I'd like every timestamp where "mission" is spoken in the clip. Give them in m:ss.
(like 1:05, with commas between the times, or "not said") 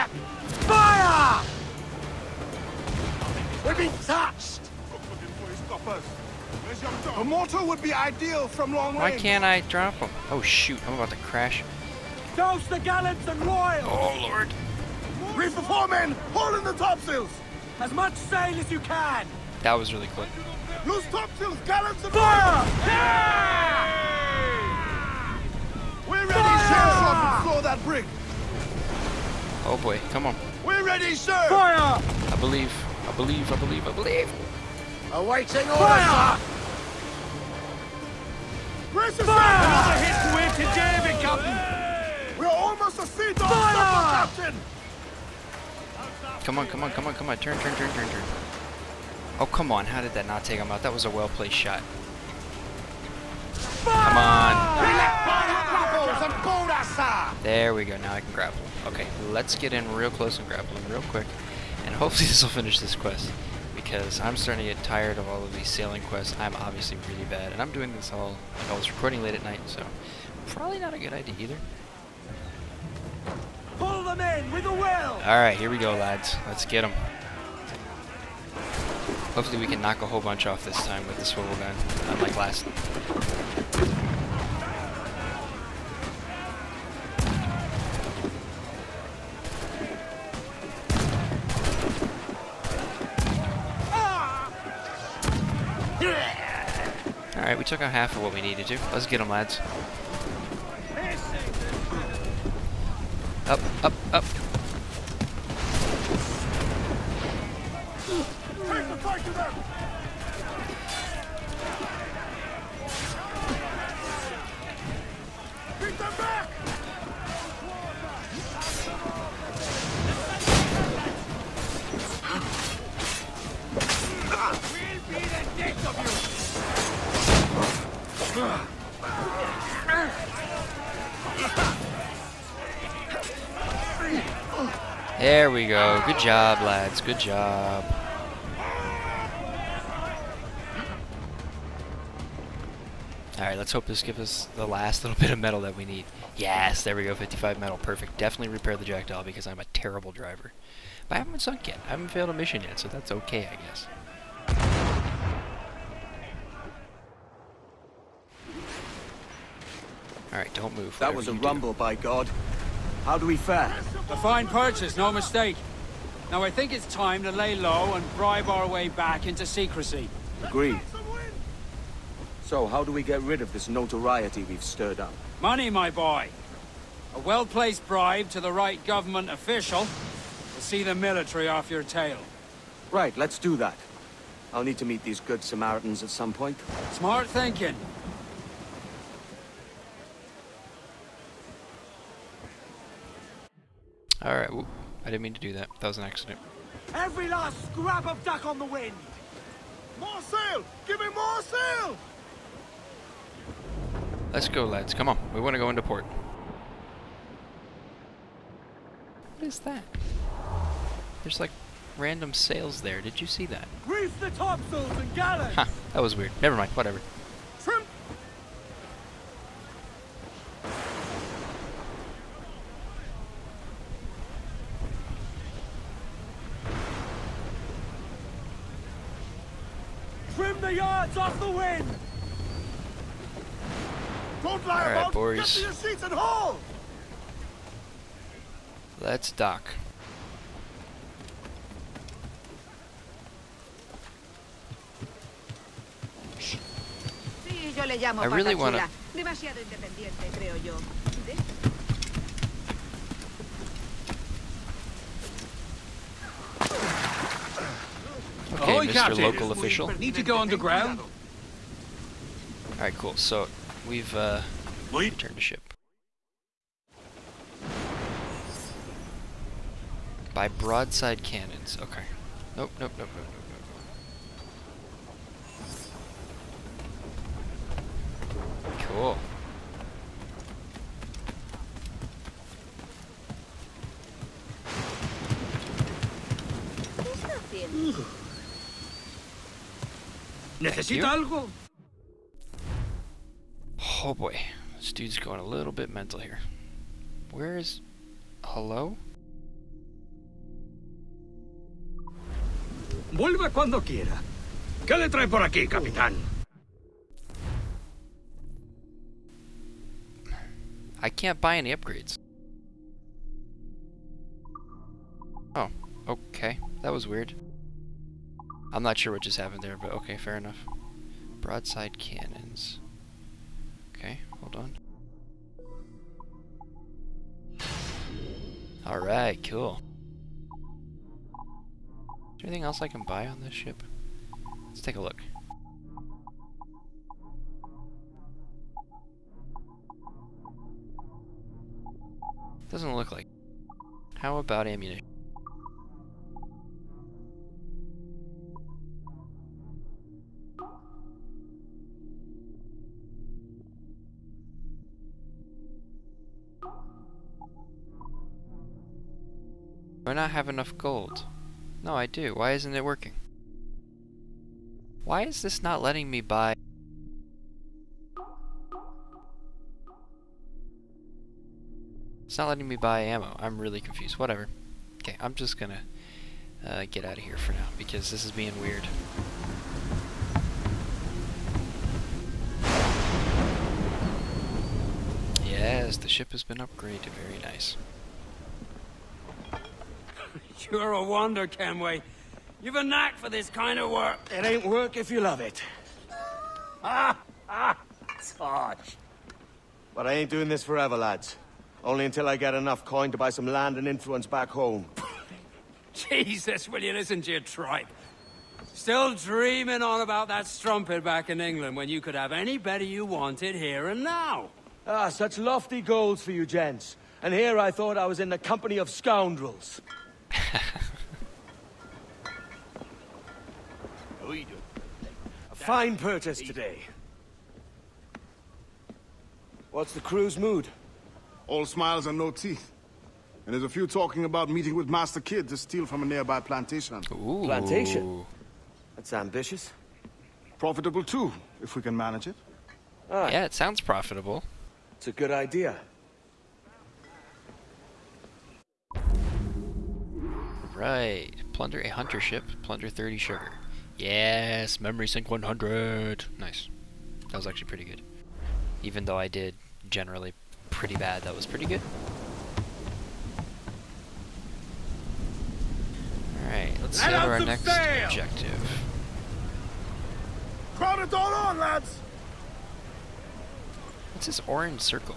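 2:32.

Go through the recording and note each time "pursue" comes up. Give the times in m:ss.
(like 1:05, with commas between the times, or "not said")
not said.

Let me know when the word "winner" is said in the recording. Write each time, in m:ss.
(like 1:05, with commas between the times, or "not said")
not said.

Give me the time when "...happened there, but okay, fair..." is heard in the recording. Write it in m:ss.
5:19.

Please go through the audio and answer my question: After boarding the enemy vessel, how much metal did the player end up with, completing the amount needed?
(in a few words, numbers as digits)
55.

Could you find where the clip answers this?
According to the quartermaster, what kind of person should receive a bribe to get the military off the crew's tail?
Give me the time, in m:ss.
2:58.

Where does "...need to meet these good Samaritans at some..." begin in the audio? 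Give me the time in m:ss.
3:04.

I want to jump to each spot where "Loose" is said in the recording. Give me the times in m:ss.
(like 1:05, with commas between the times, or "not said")
0:20.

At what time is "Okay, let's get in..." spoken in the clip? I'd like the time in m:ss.
0:58.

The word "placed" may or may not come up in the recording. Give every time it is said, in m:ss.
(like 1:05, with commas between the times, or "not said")
0:51, 2:57.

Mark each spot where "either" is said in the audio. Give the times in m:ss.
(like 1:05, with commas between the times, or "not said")
1:11.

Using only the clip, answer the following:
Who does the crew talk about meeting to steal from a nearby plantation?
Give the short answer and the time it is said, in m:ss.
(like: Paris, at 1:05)
Master Kidd, at 7:14.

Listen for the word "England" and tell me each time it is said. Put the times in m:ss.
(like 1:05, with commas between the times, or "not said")
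6:51.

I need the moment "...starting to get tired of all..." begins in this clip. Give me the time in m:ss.
1:04.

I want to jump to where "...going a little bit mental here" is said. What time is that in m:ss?
4:55.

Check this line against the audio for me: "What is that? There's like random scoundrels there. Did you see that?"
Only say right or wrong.
wrong.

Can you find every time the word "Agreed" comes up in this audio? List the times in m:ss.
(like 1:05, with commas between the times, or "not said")
2:50.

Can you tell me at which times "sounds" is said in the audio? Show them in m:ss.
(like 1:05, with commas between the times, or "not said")
7:23.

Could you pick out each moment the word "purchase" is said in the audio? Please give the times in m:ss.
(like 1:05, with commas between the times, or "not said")
2:44, 7:05.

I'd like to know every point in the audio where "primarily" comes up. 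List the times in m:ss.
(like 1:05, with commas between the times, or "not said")
not said.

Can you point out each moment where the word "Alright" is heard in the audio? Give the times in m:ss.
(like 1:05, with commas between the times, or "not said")
1:15, 1:35, 2:23, 3:14, 5:28, 7:30, 7:46.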